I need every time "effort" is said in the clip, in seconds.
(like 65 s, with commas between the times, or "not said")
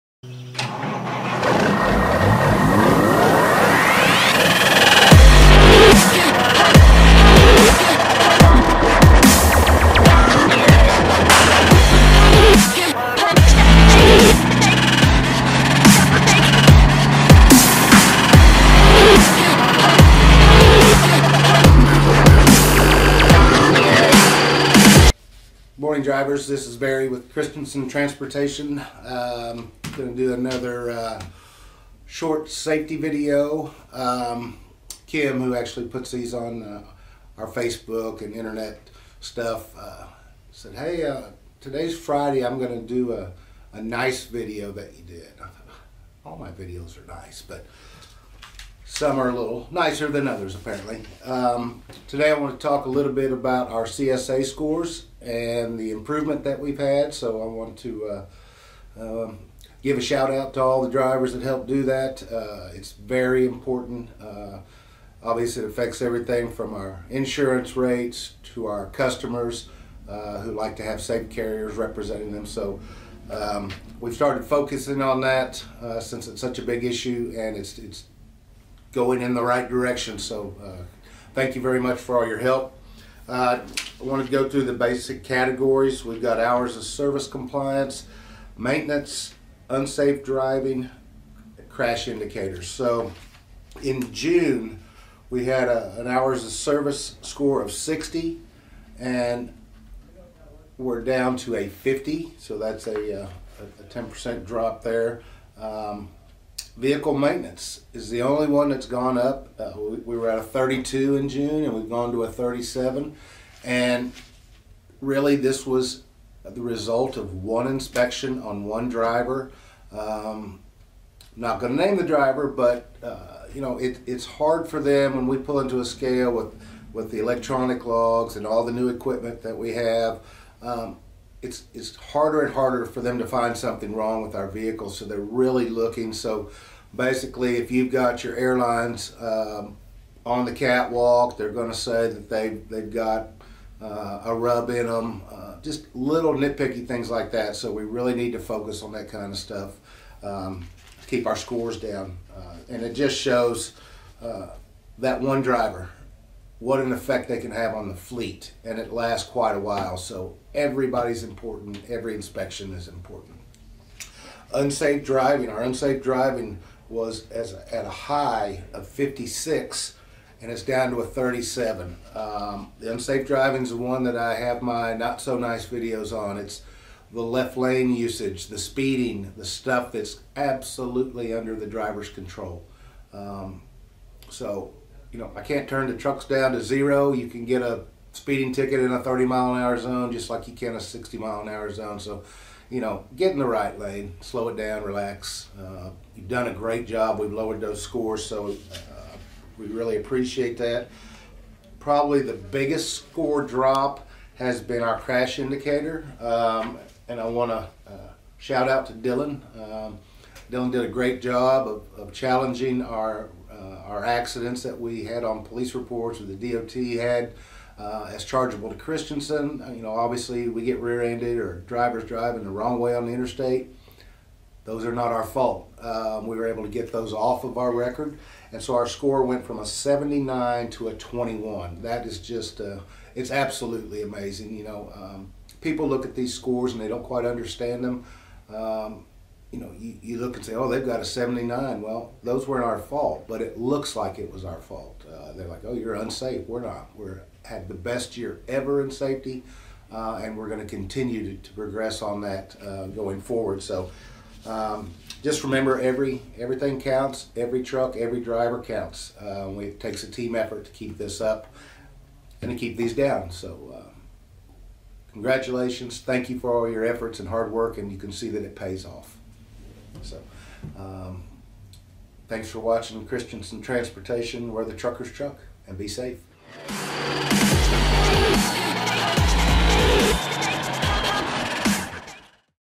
260 s, 266 s.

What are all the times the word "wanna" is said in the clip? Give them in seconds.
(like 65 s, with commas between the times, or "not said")
not said.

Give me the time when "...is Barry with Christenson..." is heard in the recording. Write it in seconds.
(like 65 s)
26 s.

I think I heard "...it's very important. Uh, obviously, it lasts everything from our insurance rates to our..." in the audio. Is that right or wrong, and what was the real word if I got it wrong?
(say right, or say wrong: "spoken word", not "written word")
wrong: "affects", not "lasts".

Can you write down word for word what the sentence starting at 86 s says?
We've got hours of service compliance, maintenance, unsafe driving, crash indicators.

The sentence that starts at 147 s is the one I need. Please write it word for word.
So we really need to focus on that kind of stuff.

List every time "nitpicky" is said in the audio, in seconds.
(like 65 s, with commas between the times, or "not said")
146 s.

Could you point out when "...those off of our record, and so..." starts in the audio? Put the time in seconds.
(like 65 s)
226 s.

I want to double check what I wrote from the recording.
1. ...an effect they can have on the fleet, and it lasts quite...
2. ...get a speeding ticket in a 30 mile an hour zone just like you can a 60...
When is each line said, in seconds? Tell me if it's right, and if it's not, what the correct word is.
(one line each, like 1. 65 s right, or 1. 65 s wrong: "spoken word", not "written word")
1. 156 s right
2. 187 s right.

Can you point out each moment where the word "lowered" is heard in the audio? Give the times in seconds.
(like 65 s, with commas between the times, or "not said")
197 s.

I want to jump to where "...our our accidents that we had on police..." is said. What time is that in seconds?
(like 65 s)
212 s.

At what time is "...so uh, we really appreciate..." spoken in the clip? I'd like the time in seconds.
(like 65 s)
198 s.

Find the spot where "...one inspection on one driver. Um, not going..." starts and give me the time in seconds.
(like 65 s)
117 s.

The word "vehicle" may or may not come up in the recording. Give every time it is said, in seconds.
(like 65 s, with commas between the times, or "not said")
106 s, 134 s.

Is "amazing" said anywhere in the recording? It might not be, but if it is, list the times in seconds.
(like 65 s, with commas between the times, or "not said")
234 s.